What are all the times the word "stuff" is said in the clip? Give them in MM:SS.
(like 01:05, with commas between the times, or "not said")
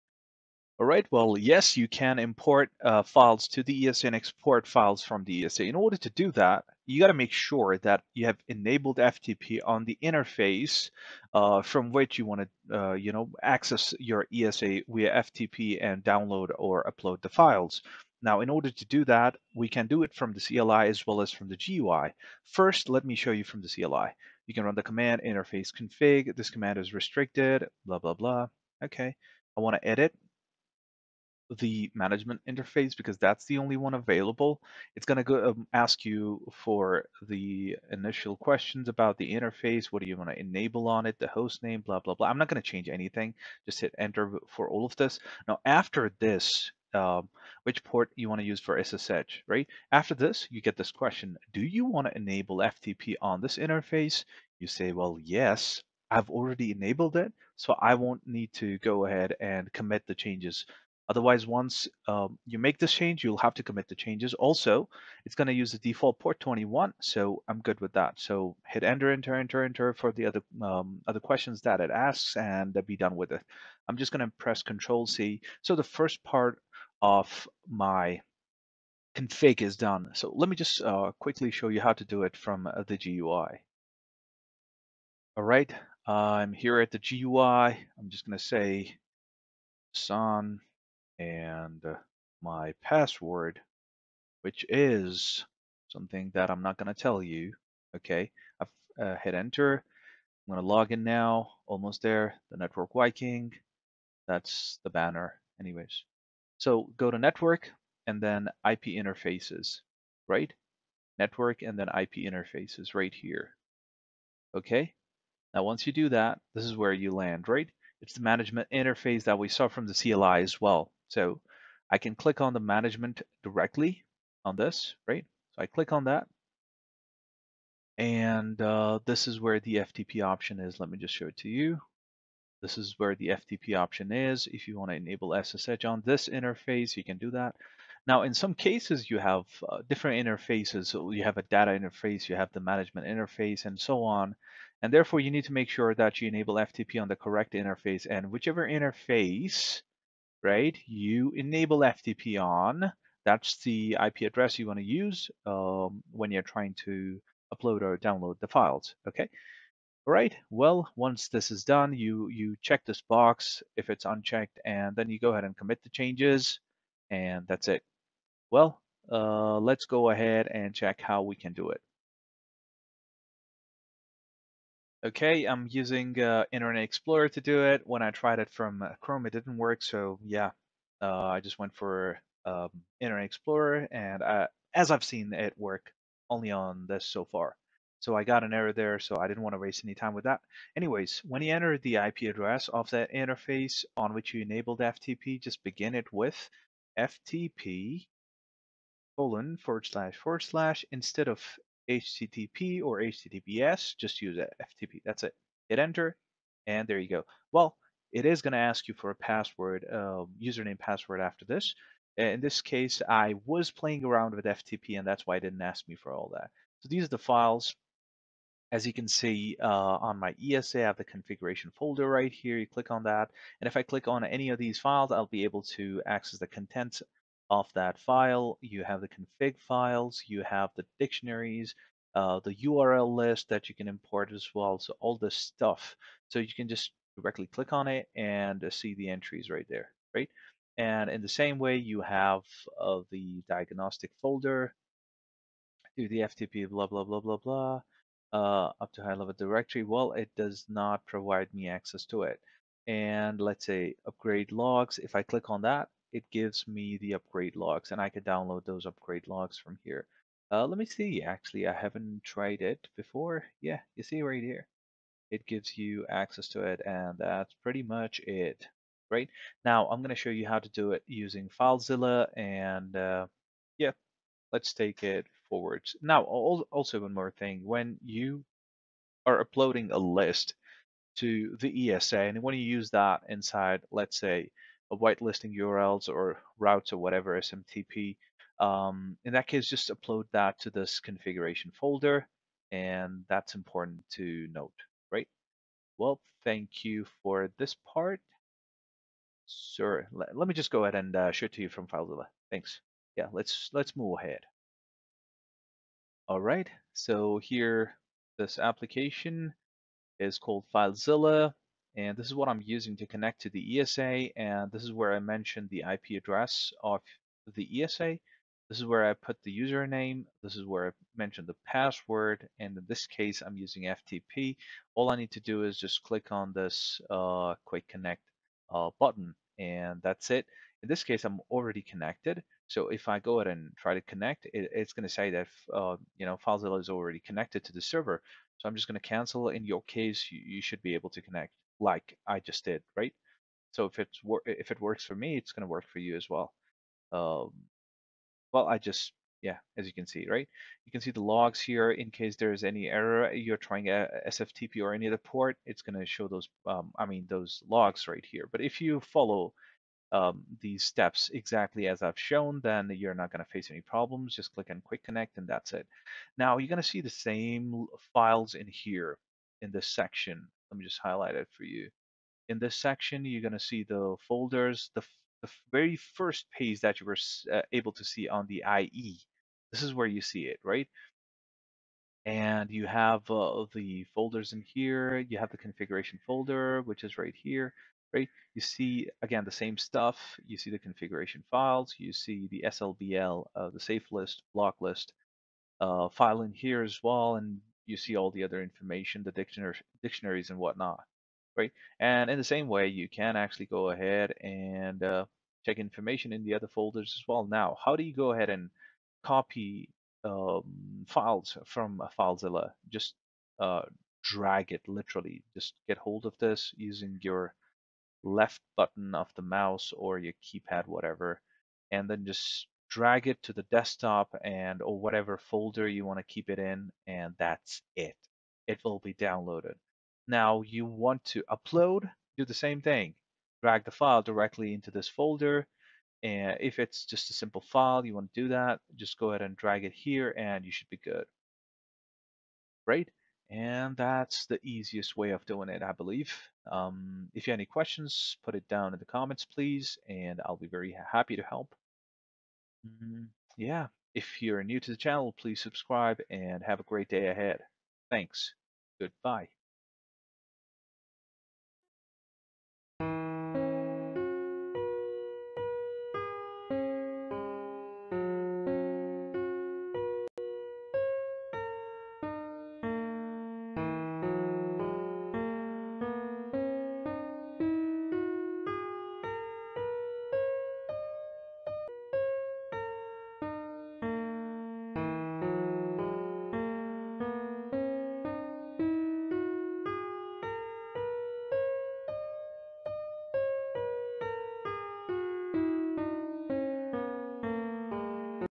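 03:55, 06:29.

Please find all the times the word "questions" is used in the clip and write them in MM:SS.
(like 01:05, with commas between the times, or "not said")
00:38, 00:50, 01:11, 07:27.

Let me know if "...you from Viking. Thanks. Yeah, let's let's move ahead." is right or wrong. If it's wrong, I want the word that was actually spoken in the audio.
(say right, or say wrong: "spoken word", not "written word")
wrong: "FileZilla", not "Viking".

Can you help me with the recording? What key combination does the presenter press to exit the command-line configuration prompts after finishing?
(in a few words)
Control C.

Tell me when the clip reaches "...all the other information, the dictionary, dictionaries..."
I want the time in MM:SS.
06:38.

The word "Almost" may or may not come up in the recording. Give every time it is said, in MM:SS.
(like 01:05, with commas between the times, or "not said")
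01:41.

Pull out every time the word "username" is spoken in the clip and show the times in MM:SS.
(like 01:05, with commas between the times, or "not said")
03:30, 05:19.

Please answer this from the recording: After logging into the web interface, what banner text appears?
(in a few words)
The network Viking.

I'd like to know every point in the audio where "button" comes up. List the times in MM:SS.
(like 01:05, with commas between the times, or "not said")
05:28, 06:58.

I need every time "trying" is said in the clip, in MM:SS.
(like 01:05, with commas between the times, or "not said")
02:36, 05:53.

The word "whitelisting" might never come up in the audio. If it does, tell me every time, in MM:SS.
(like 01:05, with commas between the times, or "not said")
04:44.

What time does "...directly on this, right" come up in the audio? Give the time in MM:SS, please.
02:03.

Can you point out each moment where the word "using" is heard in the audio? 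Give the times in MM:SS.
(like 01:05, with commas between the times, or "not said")
02:55, 04:31, 05:12, 05:23, 06:56.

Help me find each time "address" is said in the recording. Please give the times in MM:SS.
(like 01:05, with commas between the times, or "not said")
02:34, 03:12, 05:16.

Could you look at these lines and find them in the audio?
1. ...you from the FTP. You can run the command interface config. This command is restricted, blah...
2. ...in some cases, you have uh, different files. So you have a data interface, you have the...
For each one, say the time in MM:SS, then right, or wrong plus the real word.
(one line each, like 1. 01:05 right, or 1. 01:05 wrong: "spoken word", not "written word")
1. 00:23 wrong: "CLI", not "FTP"
2. 02:18 wrong: "interfaces", not "files".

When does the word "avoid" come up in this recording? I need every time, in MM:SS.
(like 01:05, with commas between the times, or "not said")
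not said.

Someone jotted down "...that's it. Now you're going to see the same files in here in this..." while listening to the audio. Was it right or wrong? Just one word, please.
right.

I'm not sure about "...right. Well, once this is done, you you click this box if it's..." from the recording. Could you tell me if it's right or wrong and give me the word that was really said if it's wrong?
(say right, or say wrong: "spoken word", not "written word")
wrong: "check", not "click".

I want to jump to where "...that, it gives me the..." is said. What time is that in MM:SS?
04:15.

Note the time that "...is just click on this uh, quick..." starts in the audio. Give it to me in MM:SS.
05:25.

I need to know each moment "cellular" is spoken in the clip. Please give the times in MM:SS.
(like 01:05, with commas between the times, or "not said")
not said.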